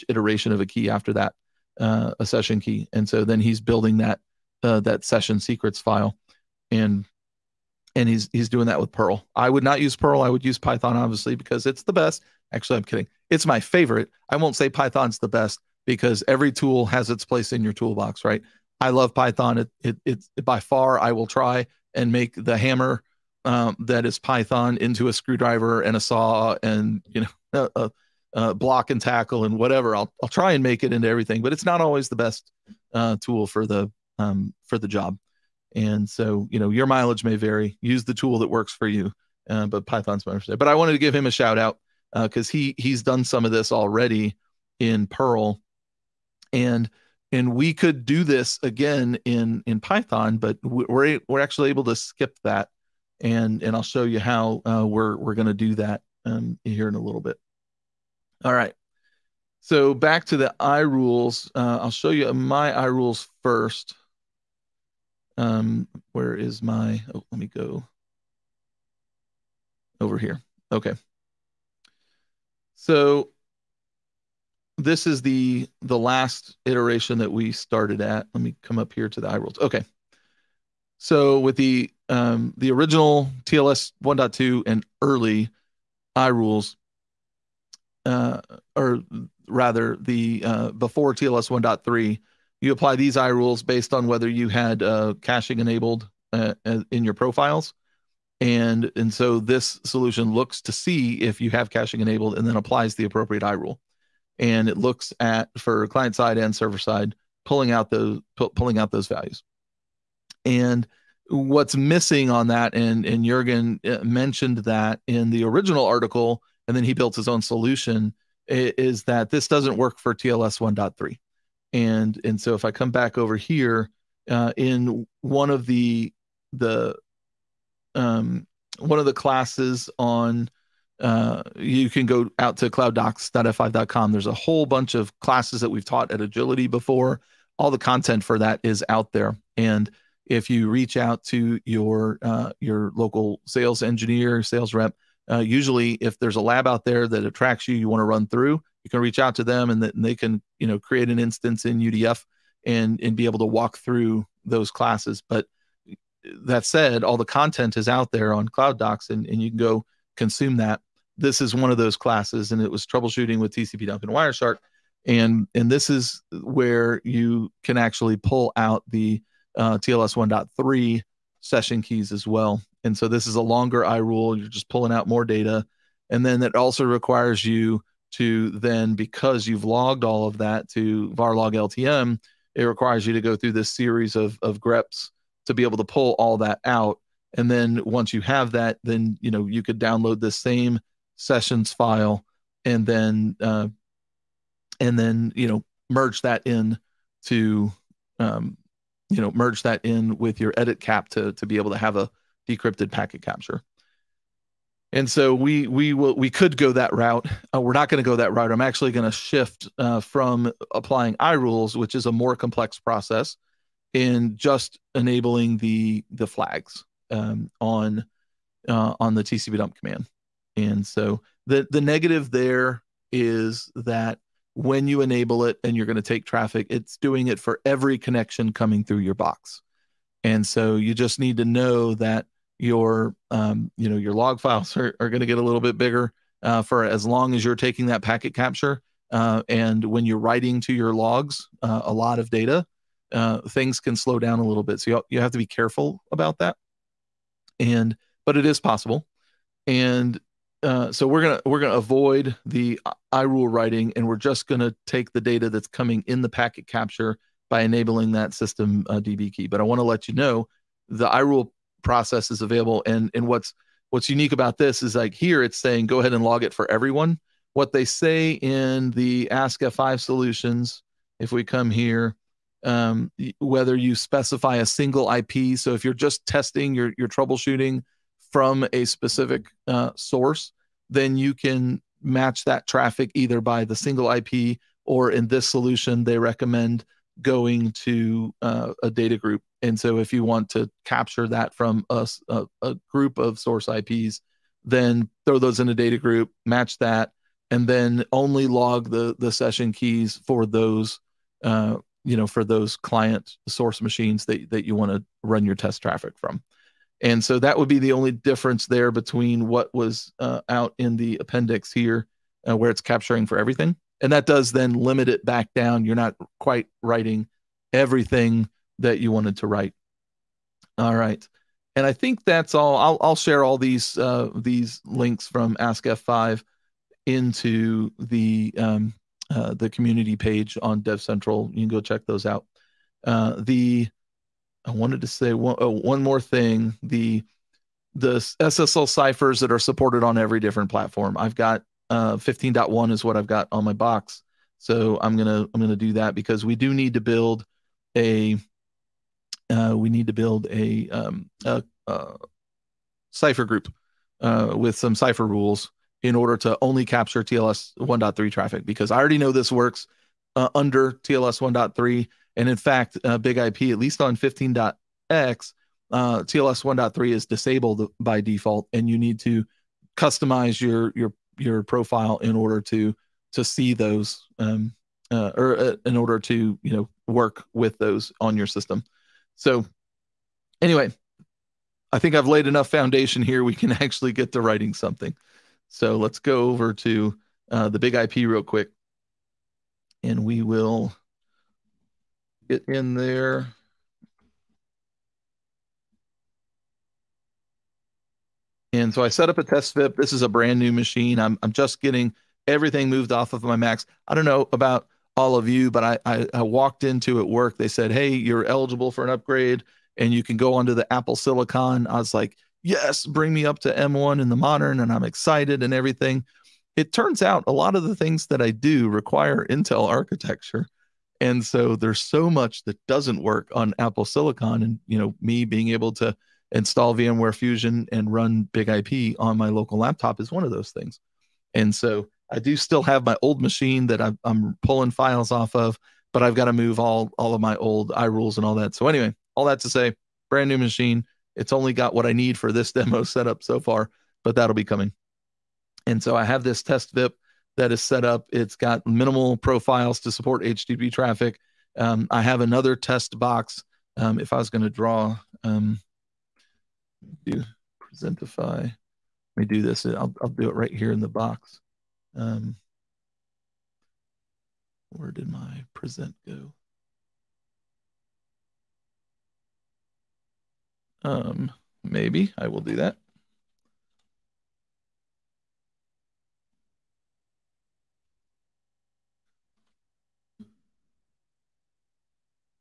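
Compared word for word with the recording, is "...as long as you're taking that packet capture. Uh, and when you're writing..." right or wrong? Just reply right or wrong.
right.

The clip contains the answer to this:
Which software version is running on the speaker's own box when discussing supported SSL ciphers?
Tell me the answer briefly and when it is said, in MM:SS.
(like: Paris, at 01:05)
15.1, at 05:42.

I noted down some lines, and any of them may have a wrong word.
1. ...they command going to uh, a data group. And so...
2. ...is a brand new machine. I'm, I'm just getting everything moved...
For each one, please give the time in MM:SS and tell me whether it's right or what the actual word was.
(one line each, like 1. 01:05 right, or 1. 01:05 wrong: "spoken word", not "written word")
1. 04:46 wrong: "recommend", not "command"
2. 06:40 right.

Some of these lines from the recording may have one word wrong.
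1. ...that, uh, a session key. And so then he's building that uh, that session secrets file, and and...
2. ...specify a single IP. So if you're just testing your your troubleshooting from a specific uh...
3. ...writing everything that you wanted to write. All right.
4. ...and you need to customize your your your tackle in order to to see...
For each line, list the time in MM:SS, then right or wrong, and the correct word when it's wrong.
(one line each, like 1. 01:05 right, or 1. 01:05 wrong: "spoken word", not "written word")
1. 00:01 right
2. 04:33 right
3. 05:16 right
4. 06:08 wrong: "profile", not "tackle".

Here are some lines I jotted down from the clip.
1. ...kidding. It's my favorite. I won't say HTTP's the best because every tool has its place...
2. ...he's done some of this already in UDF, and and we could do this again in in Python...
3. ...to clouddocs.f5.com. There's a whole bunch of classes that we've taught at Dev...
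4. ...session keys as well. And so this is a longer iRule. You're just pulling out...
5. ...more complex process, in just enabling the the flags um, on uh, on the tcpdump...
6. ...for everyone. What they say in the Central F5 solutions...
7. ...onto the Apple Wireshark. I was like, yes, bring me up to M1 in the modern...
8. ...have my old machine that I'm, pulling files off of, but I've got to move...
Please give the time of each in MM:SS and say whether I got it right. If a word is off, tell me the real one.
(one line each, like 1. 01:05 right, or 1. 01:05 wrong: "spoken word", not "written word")
1. 00:12 wrong: "Python", not "HTTP"
2. 00:42 wrong: "Perl", not "UDF"
3. 02:12 wrong: "Agility", not "Dev"
4. 02:51 right
5. 03:32 right
6. 04:26 wrong: "Ask", not "Central"
7. 06:50 wrong: "Silicon", not "Wireshark"
8. 07:12 right.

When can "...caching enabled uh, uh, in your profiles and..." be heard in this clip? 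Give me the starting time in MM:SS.
01:35.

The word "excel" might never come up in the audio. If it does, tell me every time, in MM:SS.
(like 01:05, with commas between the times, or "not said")
not said.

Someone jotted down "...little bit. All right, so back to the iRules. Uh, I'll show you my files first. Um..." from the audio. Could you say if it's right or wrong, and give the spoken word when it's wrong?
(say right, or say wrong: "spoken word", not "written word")
wrong: "iRules", not "files".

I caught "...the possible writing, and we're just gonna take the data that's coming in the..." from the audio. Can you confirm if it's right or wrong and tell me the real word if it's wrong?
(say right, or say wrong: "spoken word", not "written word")
wrong: "iRule", not "possible".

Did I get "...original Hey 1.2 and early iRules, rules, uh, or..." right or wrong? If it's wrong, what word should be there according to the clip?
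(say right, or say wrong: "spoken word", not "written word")
wrong: "TLS", not "Hey".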